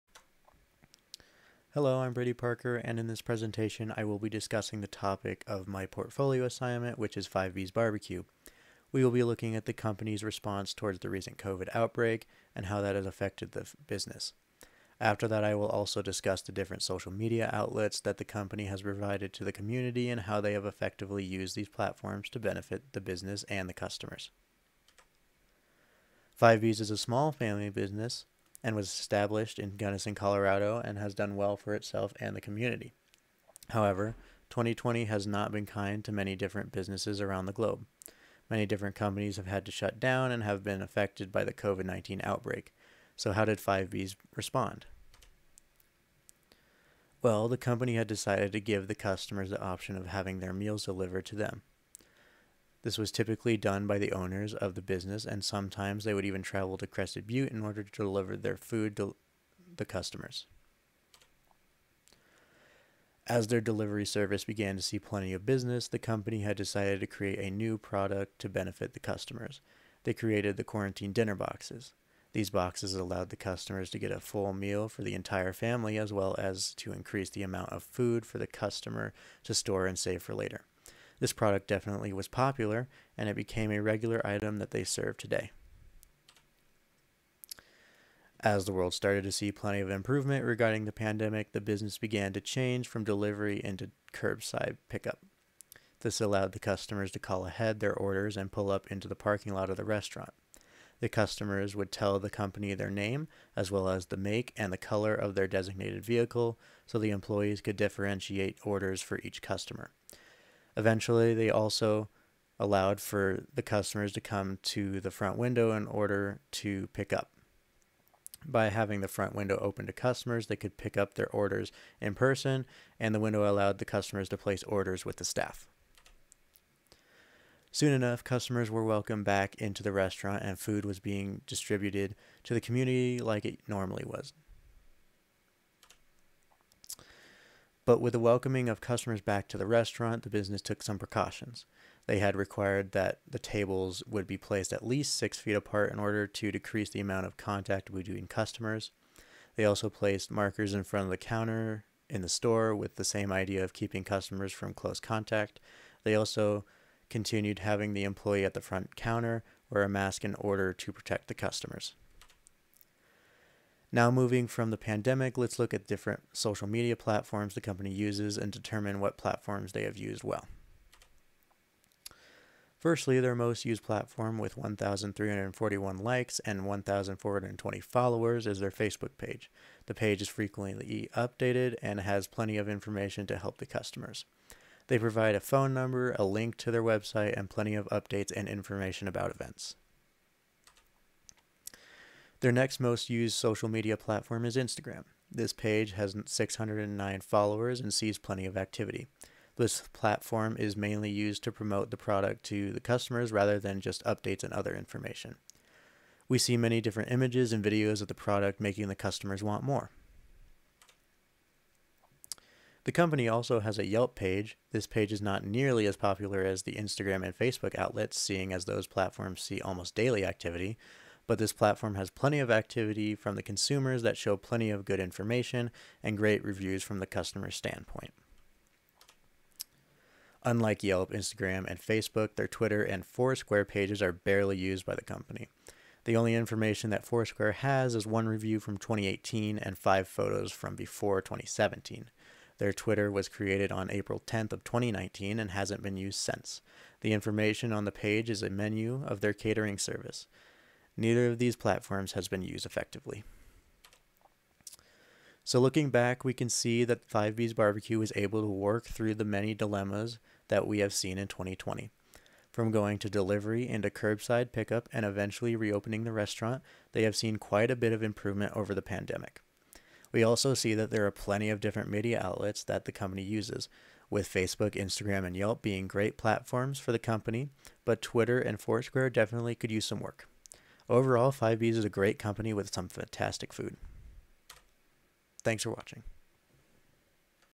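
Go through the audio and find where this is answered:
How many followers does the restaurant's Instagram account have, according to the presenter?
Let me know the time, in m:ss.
3:16.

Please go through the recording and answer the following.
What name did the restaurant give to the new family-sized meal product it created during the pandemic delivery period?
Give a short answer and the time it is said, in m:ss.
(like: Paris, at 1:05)
quarantine dinner boxes, at 1:10.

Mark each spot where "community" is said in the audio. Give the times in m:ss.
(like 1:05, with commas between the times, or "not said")
0:19, 0:32, 2:12.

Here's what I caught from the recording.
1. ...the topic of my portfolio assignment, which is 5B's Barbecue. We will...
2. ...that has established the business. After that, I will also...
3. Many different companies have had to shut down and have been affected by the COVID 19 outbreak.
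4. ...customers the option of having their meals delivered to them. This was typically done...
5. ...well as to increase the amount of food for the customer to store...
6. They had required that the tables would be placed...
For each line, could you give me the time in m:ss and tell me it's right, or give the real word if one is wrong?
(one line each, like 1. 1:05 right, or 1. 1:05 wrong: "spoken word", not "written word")
1. 0:04 right
2. 0:12 wrong: "affected", not "established"
3. 0:38 right
4. 0:48 right
5. 1:16 right
6. 2:22 right.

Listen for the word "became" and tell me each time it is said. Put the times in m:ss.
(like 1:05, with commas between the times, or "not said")
1:23.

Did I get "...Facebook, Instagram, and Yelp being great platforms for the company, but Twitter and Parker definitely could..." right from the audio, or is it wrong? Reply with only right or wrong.
wrong.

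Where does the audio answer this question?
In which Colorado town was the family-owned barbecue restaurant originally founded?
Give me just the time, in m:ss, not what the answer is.
0:29.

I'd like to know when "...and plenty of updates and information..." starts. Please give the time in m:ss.
3:07.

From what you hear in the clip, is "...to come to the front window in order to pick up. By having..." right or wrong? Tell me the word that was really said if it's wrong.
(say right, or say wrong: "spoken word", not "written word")
right.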